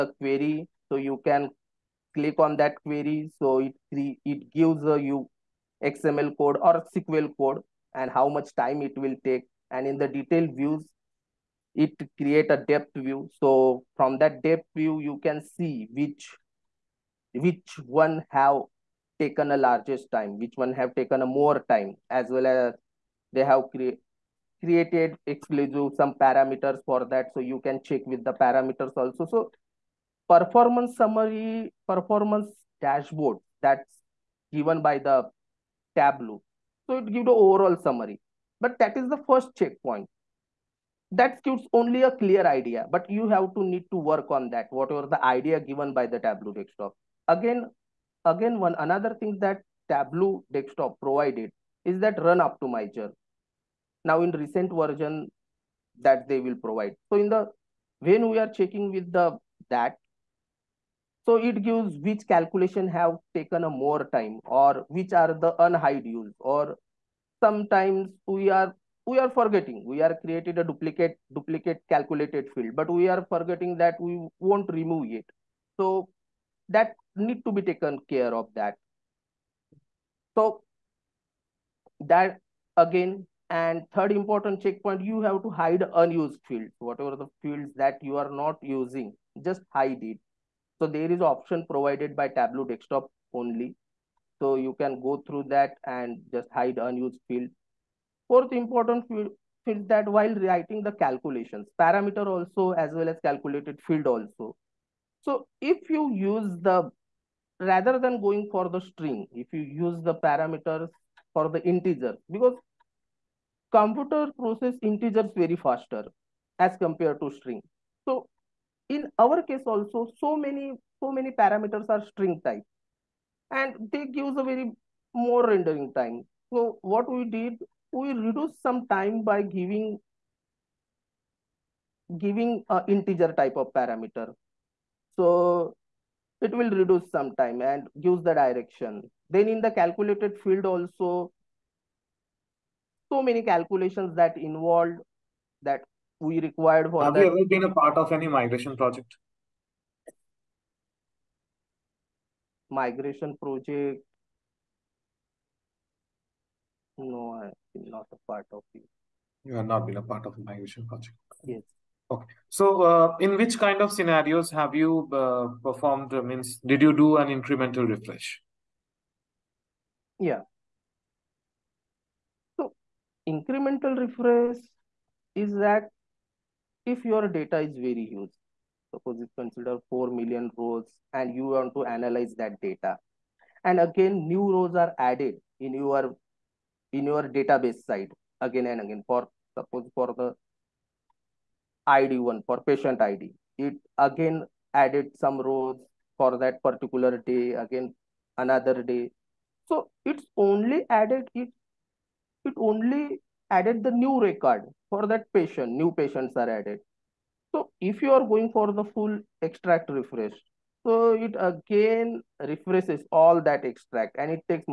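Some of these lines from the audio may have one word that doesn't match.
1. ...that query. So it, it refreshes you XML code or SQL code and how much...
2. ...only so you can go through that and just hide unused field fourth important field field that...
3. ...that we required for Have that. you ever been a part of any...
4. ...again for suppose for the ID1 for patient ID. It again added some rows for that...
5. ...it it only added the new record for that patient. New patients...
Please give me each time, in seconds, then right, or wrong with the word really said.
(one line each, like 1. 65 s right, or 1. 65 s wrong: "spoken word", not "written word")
1. 2 s wrong: "gives", not "refreshes"
2. 93 s right
3. 145 s right
4. 188 s right
5. 201 s right.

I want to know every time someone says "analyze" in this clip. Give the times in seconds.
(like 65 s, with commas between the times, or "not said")
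181 s.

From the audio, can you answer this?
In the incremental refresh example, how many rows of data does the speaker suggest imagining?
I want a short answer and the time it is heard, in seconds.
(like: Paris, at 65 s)
4 million, at 179 s.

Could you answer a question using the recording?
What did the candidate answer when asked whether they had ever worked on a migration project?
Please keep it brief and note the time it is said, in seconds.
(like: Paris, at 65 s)
No, at 156 s.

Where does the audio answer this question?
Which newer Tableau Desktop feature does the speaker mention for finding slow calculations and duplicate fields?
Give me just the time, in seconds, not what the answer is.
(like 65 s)
52 s.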